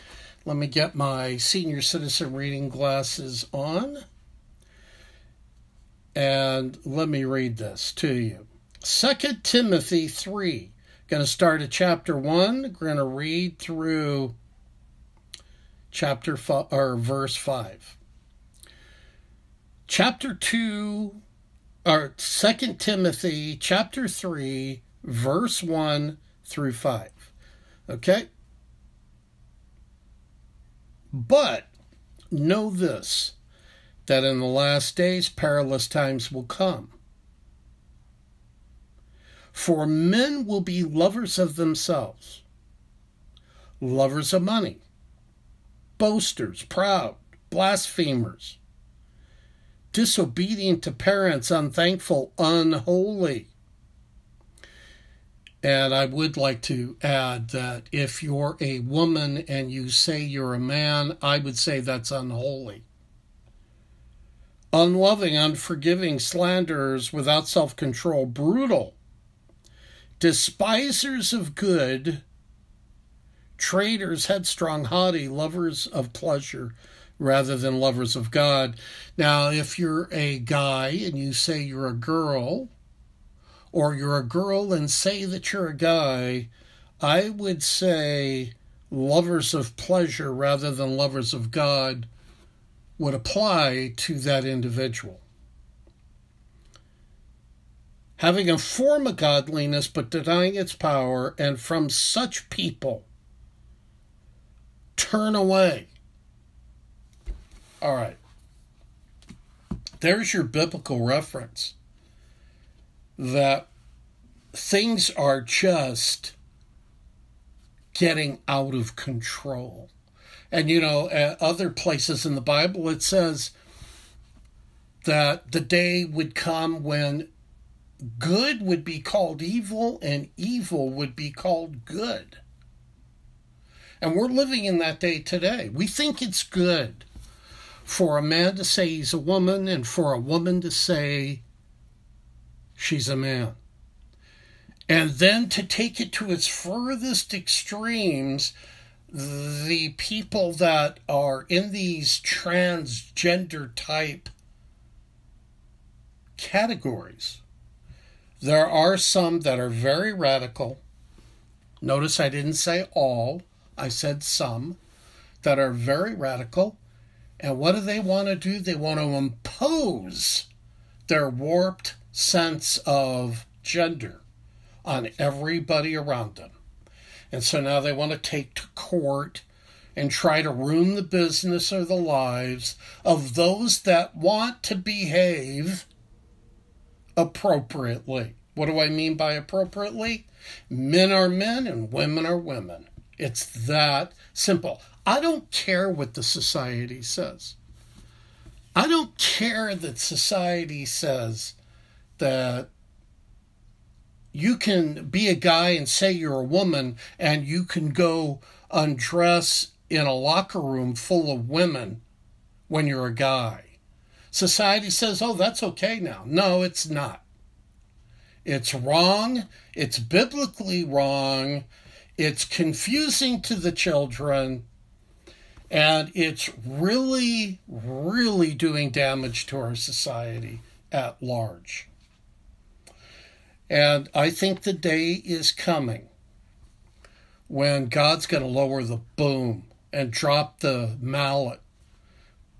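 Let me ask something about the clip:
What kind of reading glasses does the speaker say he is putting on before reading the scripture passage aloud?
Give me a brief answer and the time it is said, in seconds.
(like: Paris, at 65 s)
senior citizen, at 1 s.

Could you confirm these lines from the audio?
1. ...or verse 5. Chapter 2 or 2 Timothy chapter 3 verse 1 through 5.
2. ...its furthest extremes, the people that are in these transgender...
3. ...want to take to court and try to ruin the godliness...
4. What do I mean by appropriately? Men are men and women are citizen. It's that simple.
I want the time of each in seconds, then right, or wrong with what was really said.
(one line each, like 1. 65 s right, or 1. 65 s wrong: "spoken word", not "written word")
1. 16 s right
2. 146 s right
3. 177 s wrong: "business", not "godliness"
4. 188 s wrong: "women", not "citizen".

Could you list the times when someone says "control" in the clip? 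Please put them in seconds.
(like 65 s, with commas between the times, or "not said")
67 s, 118 s.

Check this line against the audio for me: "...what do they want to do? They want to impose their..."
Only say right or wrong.
right.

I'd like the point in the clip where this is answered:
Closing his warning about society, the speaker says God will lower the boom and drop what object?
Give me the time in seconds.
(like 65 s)
241 s.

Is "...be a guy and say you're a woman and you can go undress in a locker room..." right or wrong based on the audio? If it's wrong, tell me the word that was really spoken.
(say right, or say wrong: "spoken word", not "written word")
right.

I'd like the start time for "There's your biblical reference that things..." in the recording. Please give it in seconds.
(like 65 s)
110 s.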